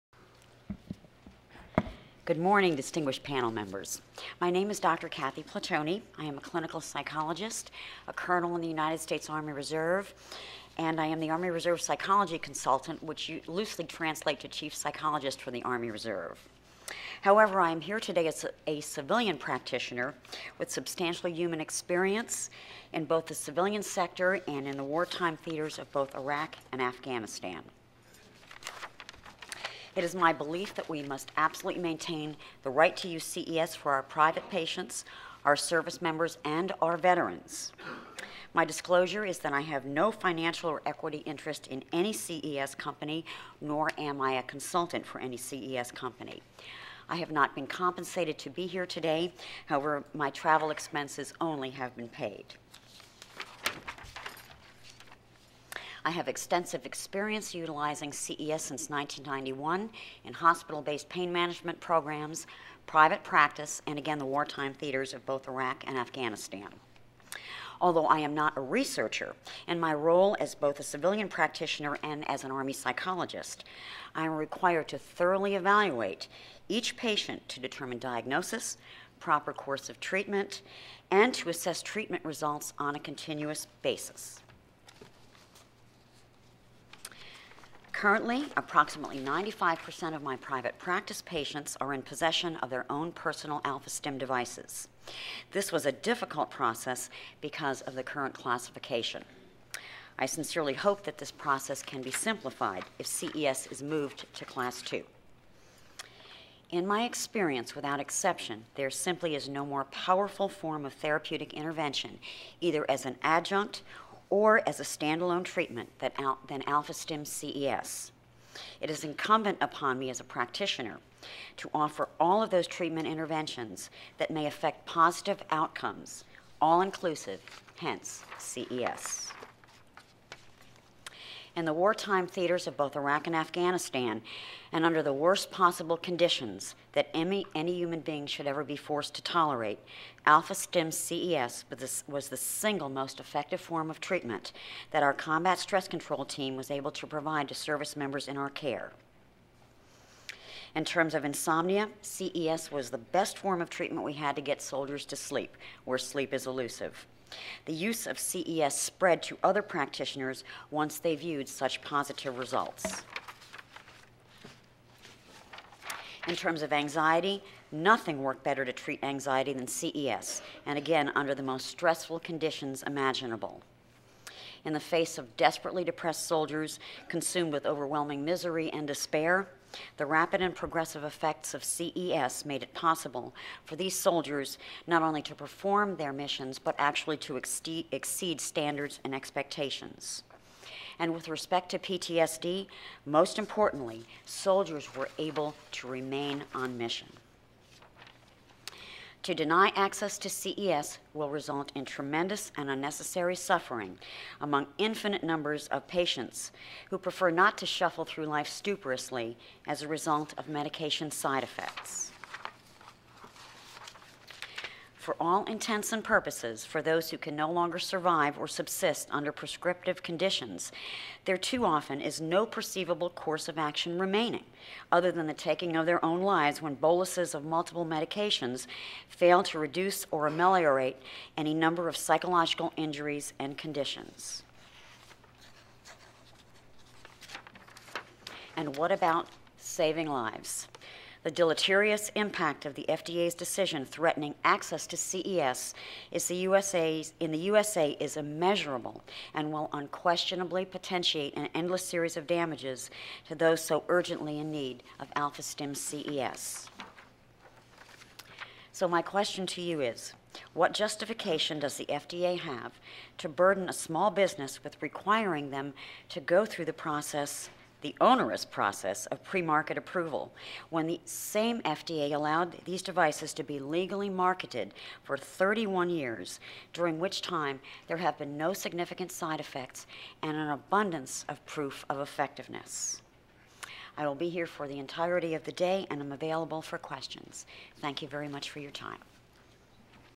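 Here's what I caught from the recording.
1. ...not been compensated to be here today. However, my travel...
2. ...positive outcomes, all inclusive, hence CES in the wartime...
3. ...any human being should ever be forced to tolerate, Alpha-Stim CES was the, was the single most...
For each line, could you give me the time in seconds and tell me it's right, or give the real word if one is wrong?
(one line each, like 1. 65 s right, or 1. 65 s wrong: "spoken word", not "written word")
1. 47 s right
2. 124 s right
3. 137 s right.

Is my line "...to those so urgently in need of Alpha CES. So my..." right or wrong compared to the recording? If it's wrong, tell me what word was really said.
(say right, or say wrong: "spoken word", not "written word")
right.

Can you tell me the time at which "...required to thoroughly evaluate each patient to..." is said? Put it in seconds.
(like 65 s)
74 s.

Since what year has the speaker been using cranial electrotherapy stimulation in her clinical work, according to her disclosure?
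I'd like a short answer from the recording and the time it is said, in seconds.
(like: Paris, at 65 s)
1991, at 58 s.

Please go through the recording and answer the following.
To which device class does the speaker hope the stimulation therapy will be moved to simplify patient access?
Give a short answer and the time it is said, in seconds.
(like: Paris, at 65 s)
Class 2, at 104 s.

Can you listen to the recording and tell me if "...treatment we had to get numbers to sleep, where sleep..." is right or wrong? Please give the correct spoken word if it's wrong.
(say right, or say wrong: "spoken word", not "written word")
wrong: "soldiers", not "numbers".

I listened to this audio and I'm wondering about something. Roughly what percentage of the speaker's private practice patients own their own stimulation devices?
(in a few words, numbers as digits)
95%.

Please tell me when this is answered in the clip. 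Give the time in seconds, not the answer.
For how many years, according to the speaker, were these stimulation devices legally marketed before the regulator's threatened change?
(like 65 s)
275 s.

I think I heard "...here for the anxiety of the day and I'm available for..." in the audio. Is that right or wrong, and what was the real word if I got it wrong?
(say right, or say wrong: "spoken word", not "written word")
wrong: "entirety", not "anxiety".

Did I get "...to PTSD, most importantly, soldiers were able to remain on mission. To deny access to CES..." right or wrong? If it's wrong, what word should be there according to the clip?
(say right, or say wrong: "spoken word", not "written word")
right.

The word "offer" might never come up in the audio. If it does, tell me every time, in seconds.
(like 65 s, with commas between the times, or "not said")
121 s.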